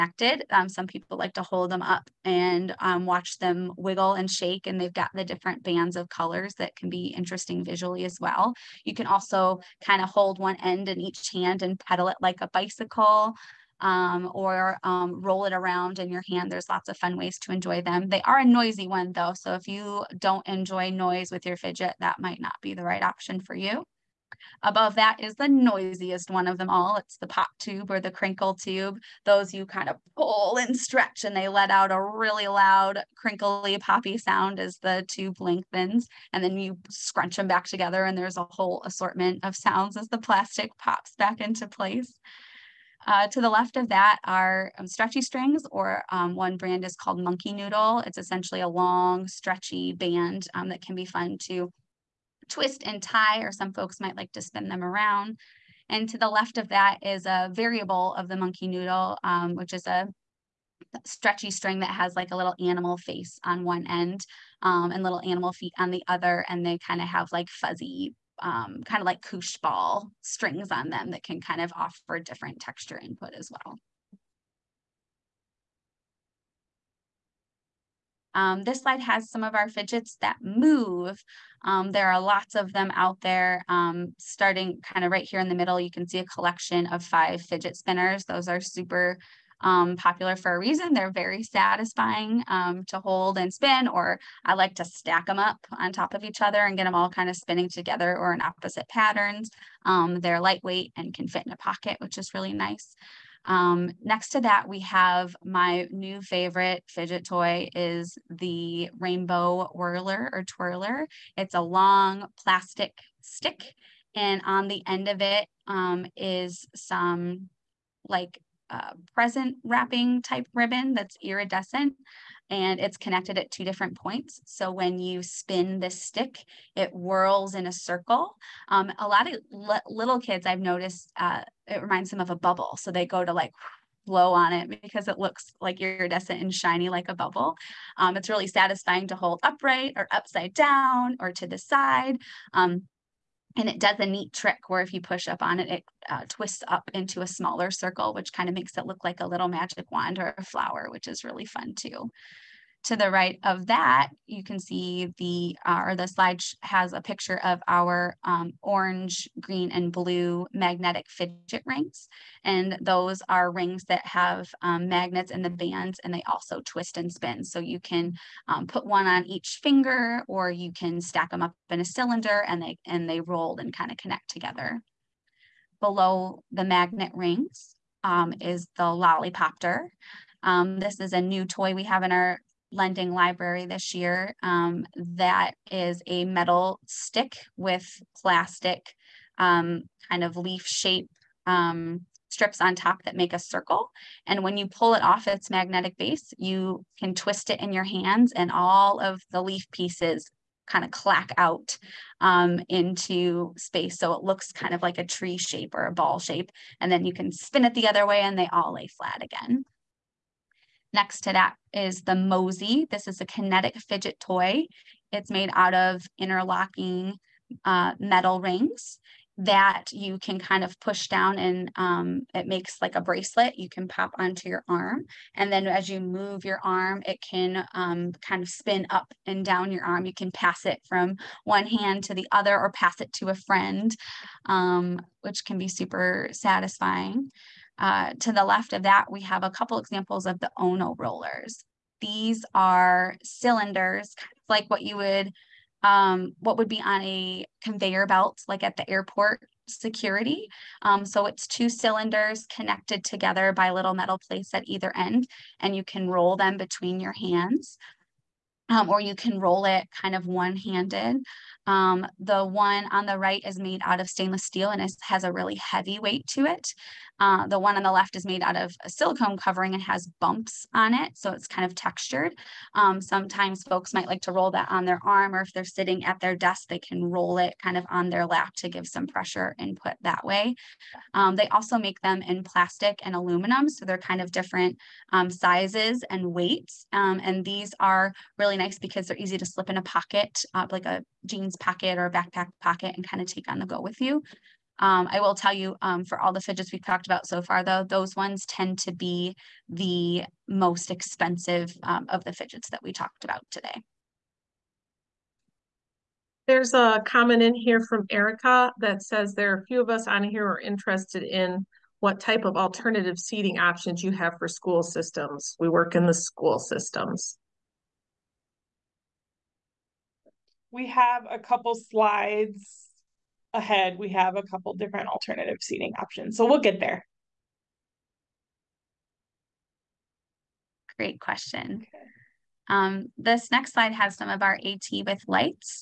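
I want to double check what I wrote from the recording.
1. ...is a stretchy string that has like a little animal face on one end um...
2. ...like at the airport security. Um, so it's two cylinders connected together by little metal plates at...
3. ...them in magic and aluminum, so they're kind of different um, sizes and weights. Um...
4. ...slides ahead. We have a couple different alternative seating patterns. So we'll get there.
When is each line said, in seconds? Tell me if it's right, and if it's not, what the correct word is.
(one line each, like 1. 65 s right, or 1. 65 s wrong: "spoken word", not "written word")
1. 59 s right
2. 248 s right
3. 281 s wrong: "plastic", not "magic"
4. 321 s wrong: "options", not "patterns".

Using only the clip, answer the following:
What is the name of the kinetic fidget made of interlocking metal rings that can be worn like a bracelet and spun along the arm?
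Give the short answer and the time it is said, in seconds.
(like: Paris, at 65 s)
Mosey, at 212 s.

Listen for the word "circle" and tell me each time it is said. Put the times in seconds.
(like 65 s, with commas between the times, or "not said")
127 s, 147 s, 193 s.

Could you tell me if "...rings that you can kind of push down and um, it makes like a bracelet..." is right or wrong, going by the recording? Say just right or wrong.
right.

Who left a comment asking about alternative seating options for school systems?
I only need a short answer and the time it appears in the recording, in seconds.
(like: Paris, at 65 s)
Erica, at 308 s.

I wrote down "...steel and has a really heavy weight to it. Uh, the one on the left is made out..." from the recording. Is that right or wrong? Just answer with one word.
right.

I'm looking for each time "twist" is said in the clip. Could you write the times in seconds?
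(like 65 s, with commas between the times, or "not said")
52 s, 146 s, 166 s, 197 s.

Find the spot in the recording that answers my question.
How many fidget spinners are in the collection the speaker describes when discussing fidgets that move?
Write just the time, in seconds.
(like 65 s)
87 s.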